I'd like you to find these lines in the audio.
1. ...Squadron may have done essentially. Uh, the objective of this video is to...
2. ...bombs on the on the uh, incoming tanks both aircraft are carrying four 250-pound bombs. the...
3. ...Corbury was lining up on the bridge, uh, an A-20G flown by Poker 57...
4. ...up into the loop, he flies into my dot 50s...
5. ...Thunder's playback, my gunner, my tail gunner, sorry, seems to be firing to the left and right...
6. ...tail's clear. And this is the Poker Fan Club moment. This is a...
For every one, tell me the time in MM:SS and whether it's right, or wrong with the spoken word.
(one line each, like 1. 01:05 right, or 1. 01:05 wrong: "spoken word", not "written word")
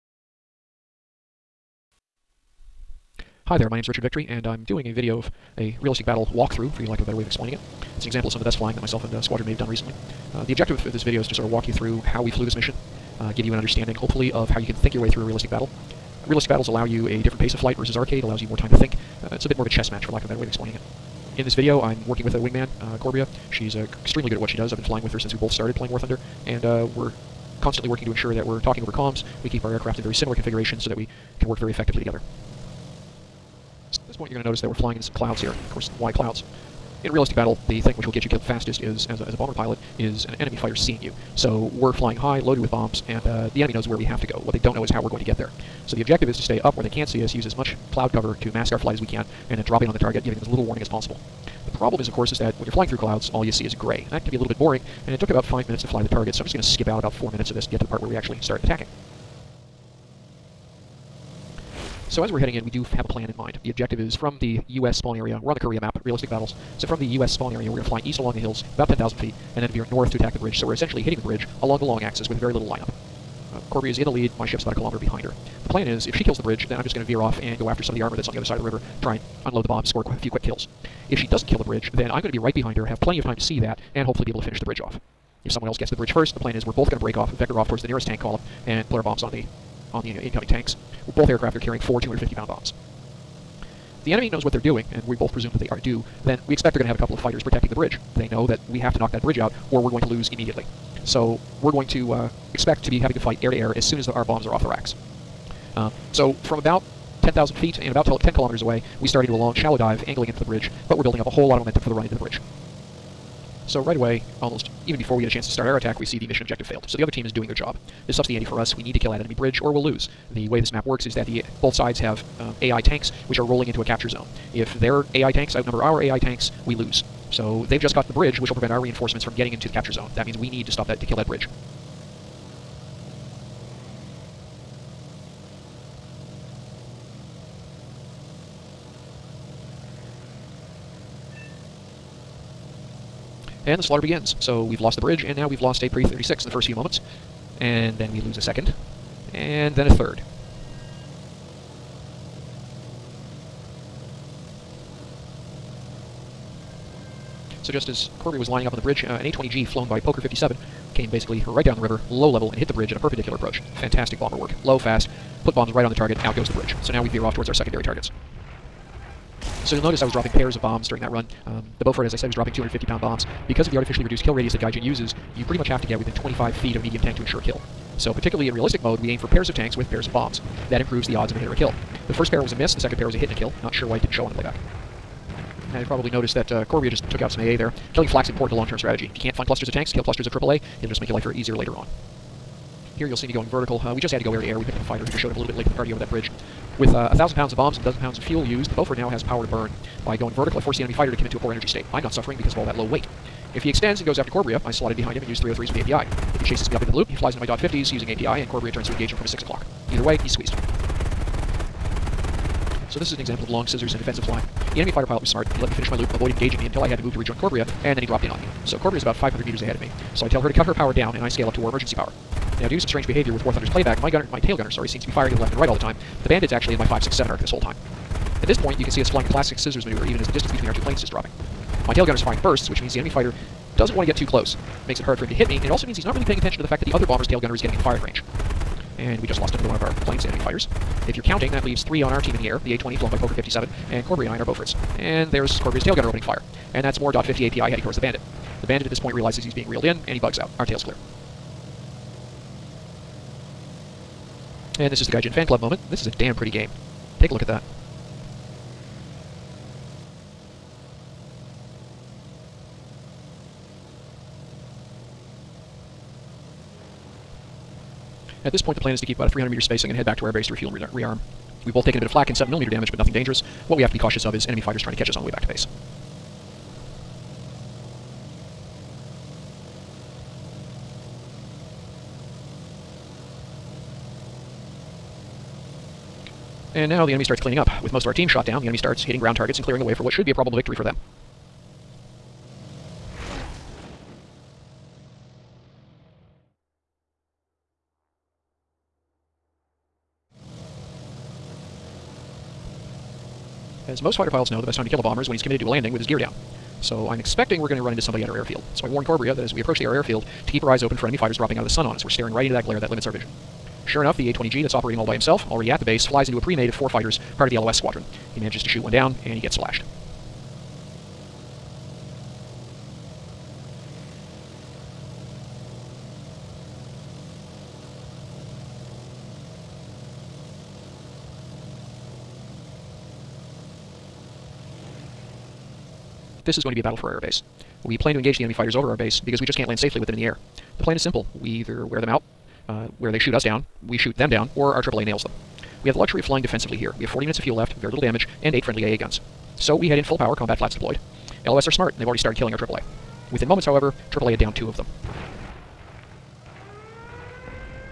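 1. 00:09 wrong: "recently", not "essentially"
2. 01:29 right
3. 02:38 right
4. 03:26 right
5. 03:43 right
6. 04:10 wrong: "Gaijin", not "Poker".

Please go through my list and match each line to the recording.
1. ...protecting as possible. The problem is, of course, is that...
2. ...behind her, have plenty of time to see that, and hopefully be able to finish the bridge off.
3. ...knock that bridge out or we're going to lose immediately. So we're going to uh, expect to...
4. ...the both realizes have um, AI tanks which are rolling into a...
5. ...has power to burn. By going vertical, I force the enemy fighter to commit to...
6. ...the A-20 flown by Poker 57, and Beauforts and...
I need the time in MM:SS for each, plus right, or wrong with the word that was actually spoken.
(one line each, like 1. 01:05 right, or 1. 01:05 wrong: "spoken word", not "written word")
1. 00:50 wrong: "warning", not "protecting"
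2. 01:22 right
3. 01:38 right
4. 02:01 wrong: "sides", not "realizes"
5. 03:19 right
6. 04:02 wrong: "Corbury", not "Beauforts".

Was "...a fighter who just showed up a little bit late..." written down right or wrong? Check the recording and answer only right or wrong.
right.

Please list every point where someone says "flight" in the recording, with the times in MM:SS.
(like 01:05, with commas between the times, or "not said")
00:17, 00:48.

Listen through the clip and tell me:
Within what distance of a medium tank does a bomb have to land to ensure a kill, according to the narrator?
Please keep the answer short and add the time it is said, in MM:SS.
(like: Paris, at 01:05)
25 feet, at 02:56.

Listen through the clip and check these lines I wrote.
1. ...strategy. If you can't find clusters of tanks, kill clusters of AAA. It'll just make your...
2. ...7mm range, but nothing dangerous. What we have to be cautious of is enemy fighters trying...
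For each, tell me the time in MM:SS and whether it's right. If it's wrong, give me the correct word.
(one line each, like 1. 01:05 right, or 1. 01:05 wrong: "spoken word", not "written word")
1. 03:08 right
2. 04:32 wrong: "damage", not "range".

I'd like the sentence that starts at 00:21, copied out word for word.
In this video, I'm working with a wingman, uh, Corbria.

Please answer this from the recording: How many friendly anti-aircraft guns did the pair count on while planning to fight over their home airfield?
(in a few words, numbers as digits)
8.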